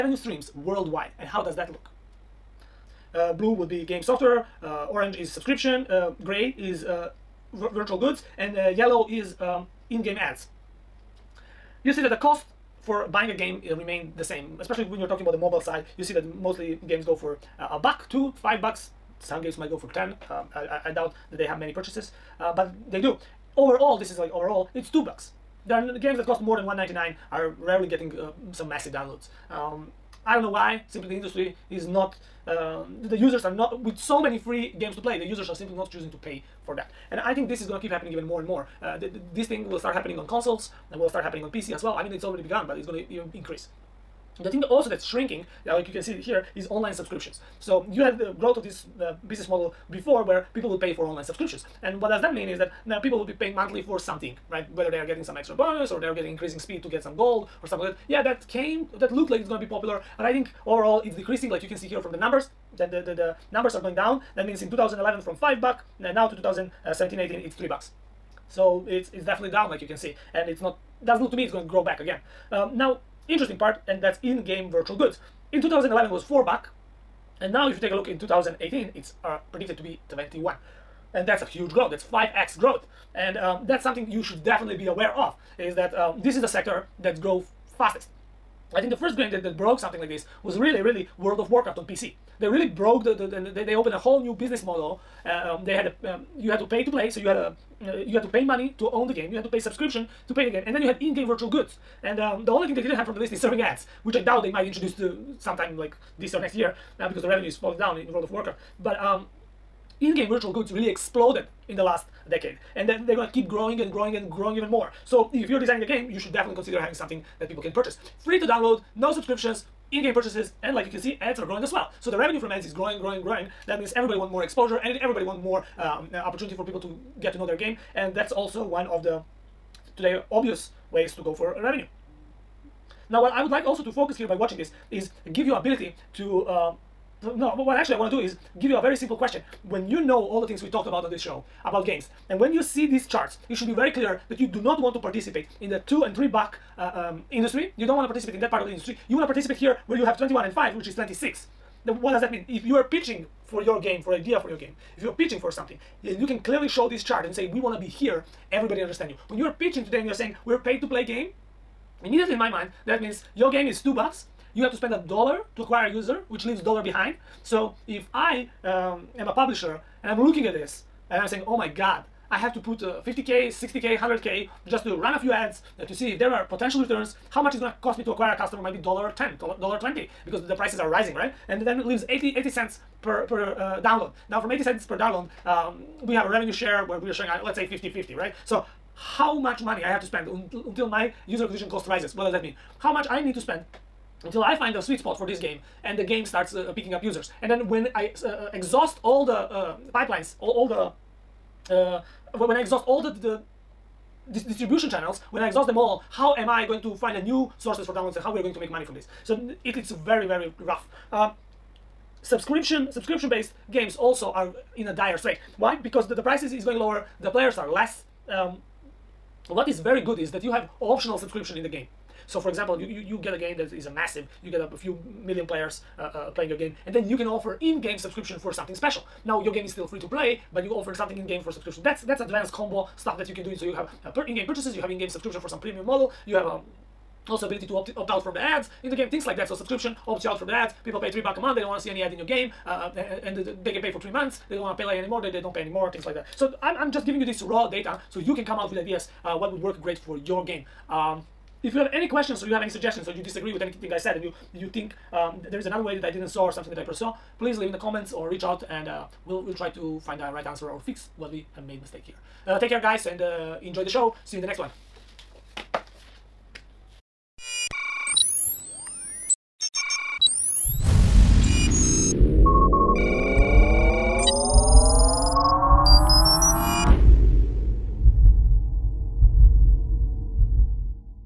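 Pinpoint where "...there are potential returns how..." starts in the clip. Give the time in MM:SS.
02:56.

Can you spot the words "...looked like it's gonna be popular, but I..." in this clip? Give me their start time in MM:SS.
00:59.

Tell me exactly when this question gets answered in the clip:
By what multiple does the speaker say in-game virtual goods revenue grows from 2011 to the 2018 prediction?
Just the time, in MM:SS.
01:22.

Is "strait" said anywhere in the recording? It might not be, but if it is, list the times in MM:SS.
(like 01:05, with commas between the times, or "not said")
03:35.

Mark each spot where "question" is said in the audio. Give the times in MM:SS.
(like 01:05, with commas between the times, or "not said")
02:19, 04:12.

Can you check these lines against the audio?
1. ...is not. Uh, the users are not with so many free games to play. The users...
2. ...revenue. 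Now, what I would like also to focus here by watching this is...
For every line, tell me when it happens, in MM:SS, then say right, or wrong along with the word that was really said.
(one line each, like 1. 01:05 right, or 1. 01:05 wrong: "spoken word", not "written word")
1. 00:31 right
2. 02:11 right.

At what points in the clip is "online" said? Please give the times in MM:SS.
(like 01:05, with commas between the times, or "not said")
00:46, 00:51.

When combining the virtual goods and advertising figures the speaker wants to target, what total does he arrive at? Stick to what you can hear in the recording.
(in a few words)
26.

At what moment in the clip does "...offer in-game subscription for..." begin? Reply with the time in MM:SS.
03:47.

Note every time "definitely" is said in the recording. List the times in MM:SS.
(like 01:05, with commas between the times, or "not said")
01:09, 01:24, 01:56.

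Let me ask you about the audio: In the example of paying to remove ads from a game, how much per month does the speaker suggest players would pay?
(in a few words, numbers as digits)
$3.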